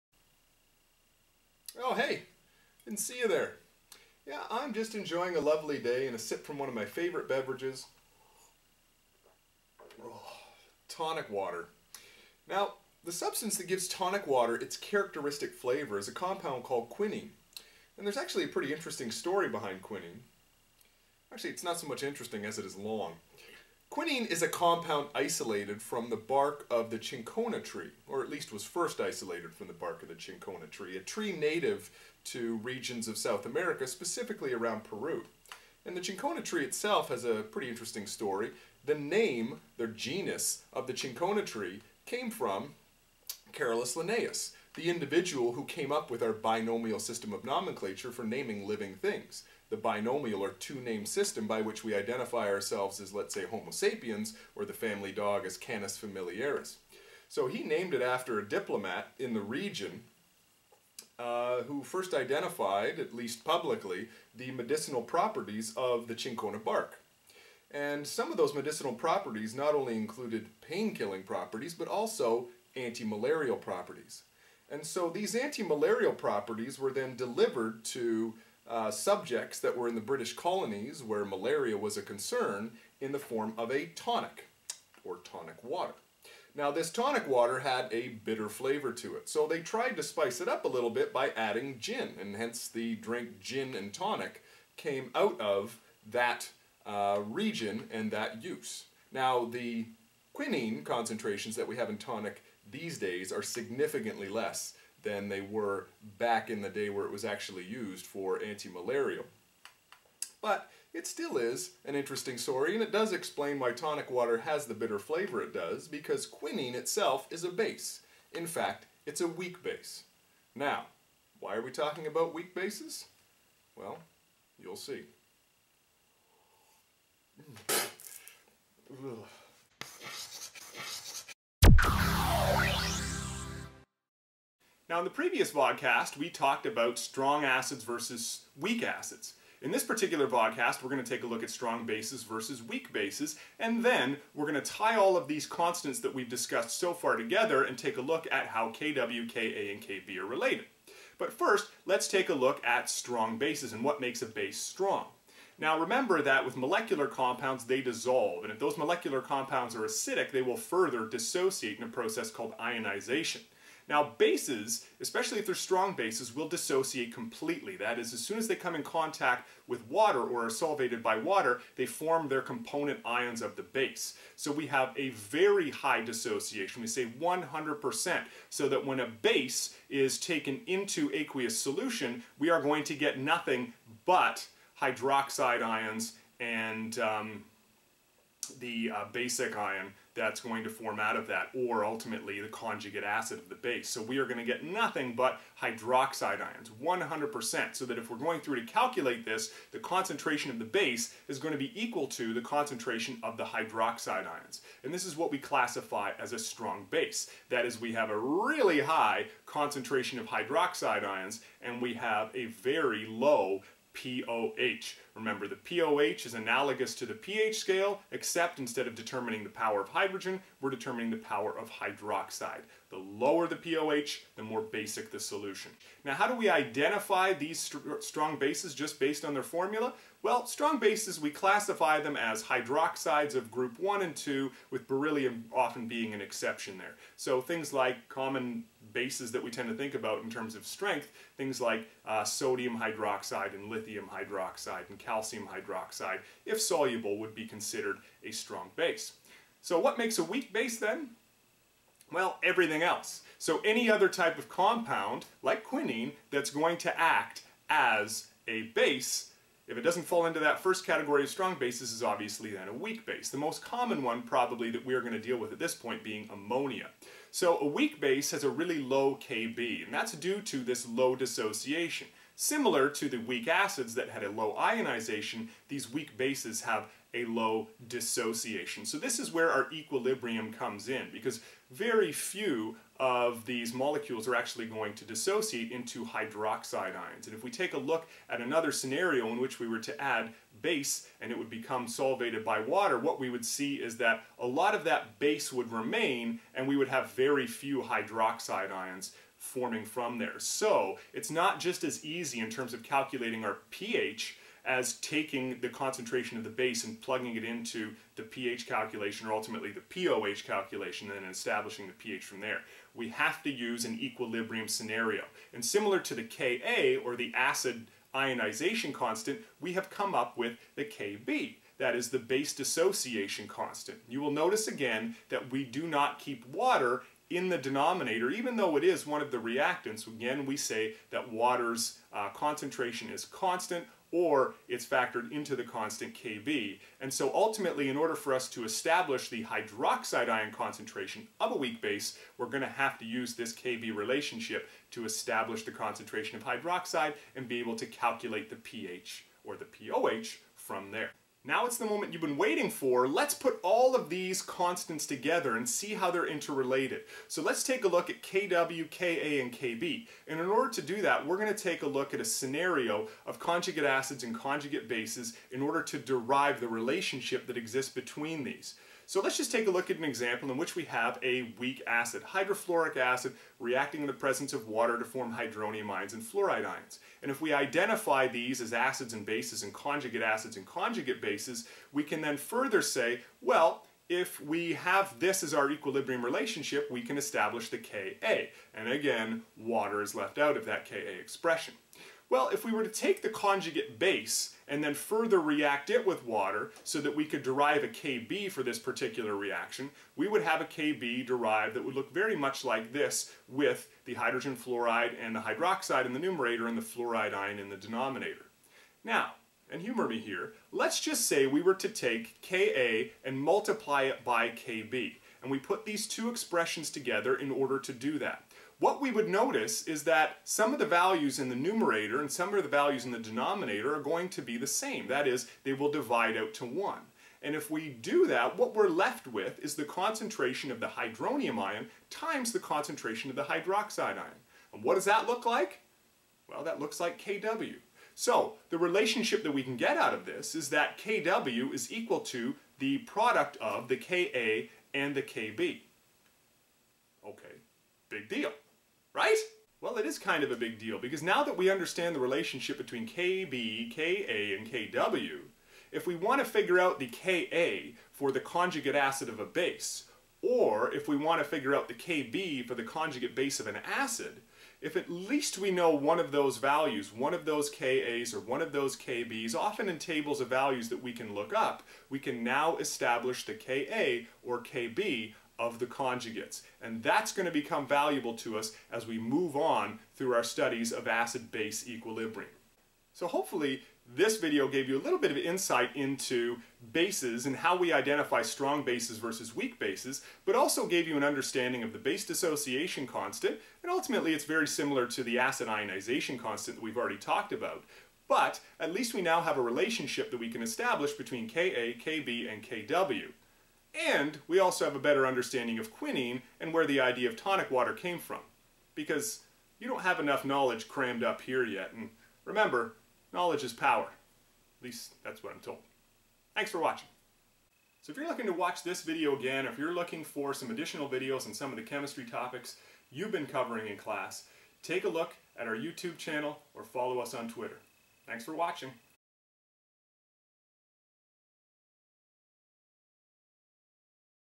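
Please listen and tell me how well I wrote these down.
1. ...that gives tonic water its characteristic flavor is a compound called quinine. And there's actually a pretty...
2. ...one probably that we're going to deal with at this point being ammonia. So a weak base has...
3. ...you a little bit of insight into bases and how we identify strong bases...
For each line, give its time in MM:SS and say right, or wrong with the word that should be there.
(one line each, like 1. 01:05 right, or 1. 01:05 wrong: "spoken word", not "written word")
1. 00:13 right
2. 04:24 right
3. 08:04 right.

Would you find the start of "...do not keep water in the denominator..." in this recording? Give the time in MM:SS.
05:25.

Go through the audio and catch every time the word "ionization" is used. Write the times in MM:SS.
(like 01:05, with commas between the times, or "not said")
02:42, 04:34, 05:18, 08:15.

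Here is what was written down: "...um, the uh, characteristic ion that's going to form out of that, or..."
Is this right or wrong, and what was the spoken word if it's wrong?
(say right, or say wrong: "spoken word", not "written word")
wrong: "basic", not "characteristic".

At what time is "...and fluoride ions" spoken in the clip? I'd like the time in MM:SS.
06:16.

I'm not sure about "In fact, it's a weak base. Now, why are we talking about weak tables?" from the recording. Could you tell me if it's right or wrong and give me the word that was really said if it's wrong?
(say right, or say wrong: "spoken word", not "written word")
wrong: "bases", not "tables".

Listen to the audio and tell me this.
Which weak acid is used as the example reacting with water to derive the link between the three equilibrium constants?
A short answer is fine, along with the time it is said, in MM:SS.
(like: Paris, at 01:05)
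Hydrofluoric acid, at 06:12.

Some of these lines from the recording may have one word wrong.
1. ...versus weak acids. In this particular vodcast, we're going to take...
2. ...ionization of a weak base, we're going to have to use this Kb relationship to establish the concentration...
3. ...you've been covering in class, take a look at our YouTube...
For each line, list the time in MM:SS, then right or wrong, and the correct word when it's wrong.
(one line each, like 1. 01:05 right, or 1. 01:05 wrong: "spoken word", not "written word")
1. 02:17 right
2. 05:40 wrong: "concentration", not "ionization"
3. 08:43 right.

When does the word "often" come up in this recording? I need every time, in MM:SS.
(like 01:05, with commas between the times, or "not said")
03:55, 07:49.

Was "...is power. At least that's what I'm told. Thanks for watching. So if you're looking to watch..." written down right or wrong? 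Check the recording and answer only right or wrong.
right.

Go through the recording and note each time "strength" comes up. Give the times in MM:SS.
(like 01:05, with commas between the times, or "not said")
04:00.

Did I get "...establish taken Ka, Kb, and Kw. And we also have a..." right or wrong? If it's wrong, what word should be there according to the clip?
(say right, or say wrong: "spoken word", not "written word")
wrong: "between", not "taken".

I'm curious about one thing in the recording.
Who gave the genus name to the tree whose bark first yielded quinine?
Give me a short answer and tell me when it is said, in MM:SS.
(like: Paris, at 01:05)
Carolus Linnaeus, at 00:43.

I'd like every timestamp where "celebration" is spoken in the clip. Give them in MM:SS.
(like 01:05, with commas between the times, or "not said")
not said.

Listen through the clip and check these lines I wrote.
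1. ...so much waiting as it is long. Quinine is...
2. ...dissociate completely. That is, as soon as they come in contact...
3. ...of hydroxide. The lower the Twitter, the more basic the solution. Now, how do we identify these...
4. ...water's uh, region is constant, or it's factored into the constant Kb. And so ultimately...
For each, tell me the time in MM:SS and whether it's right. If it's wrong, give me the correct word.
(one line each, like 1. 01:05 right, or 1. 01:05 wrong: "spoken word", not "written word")
1. 00:21 wrong: "interesting", not "waiting"
2. 02:46 right
3. 03:41 wrong: "POH", not "Twitter"
4. 05:31 wrong: "concentration", not "region".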